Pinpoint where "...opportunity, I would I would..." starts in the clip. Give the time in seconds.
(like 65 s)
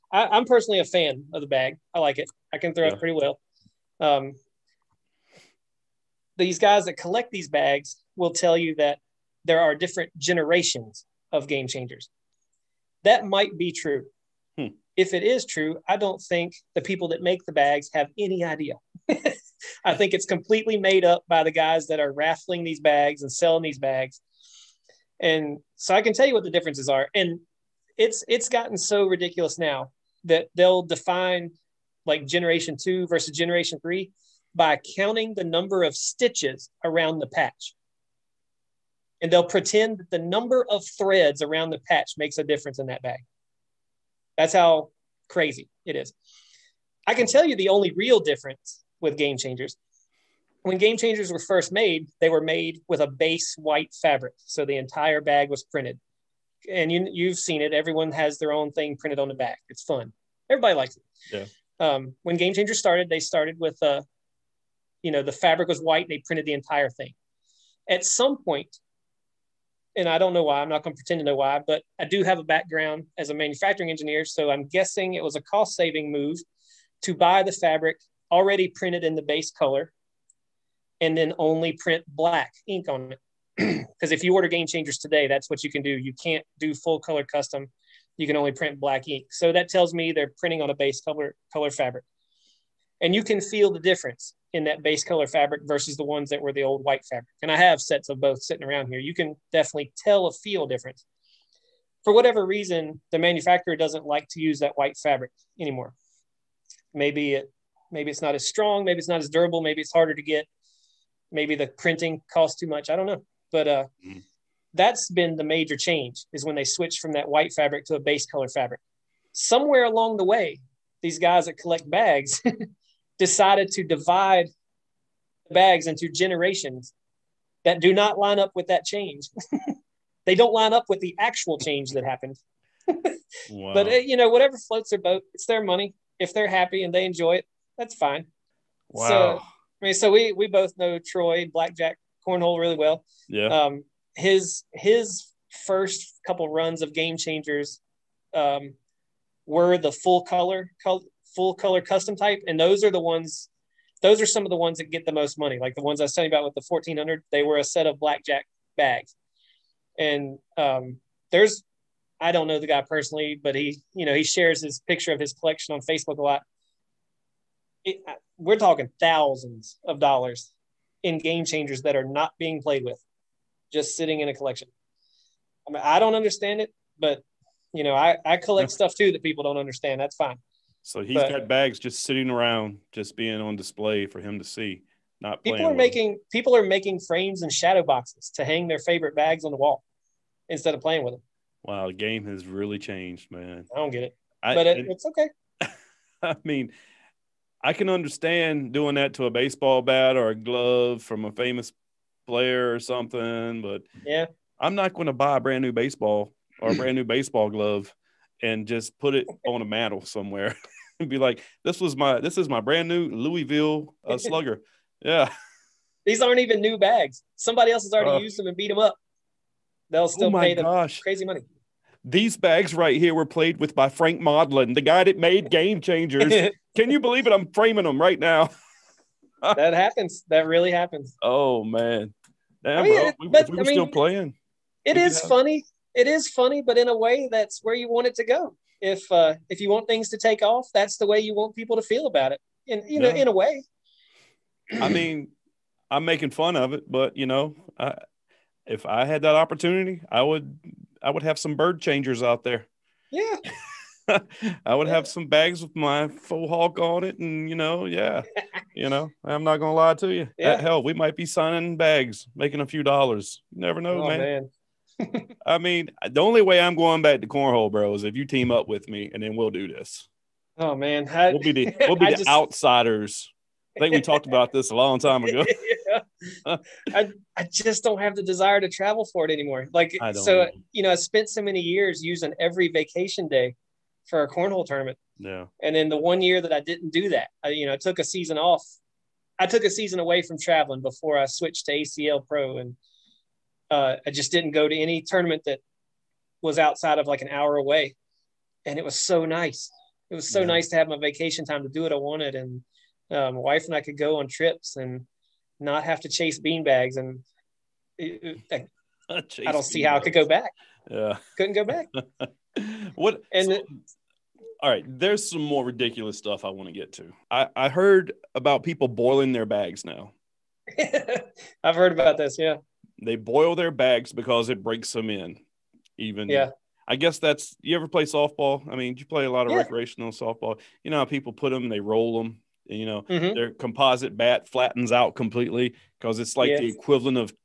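249 s.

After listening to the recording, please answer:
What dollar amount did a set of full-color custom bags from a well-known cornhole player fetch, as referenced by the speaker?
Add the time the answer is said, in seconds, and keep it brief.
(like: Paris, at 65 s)
1400, at 156 s.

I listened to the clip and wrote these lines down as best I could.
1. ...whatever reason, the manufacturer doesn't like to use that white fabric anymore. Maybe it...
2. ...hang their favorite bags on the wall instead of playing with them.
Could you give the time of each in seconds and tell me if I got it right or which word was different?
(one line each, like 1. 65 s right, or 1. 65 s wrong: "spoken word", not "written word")
1. 102 s right
2. 188 s right.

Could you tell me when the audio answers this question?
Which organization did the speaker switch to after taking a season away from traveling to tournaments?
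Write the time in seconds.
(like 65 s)
291 s.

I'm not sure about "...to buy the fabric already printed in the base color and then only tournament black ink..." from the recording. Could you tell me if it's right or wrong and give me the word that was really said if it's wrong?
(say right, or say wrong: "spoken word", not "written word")
wrong: "print", not "tournament".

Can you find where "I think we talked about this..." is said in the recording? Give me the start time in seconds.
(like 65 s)
273 s.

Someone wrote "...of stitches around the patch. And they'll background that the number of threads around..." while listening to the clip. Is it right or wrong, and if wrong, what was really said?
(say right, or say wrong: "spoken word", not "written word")
wrong: "pretend", not "background".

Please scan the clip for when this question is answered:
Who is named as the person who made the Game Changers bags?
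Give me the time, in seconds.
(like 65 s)
223 s.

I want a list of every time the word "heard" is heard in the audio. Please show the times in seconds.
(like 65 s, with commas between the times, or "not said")
317 s, 321 s.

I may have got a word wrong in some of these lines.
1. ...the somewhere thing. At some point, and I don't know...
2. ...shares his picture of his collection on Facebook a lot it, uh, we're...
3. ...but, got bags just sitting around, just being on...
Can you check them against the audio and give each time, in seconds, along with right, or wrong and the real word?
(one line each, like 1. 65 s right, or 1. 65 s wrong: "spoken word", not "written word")
1. 66 s wrong: "entire", not "somewhere"
2. 164 s right
3. 181 s right.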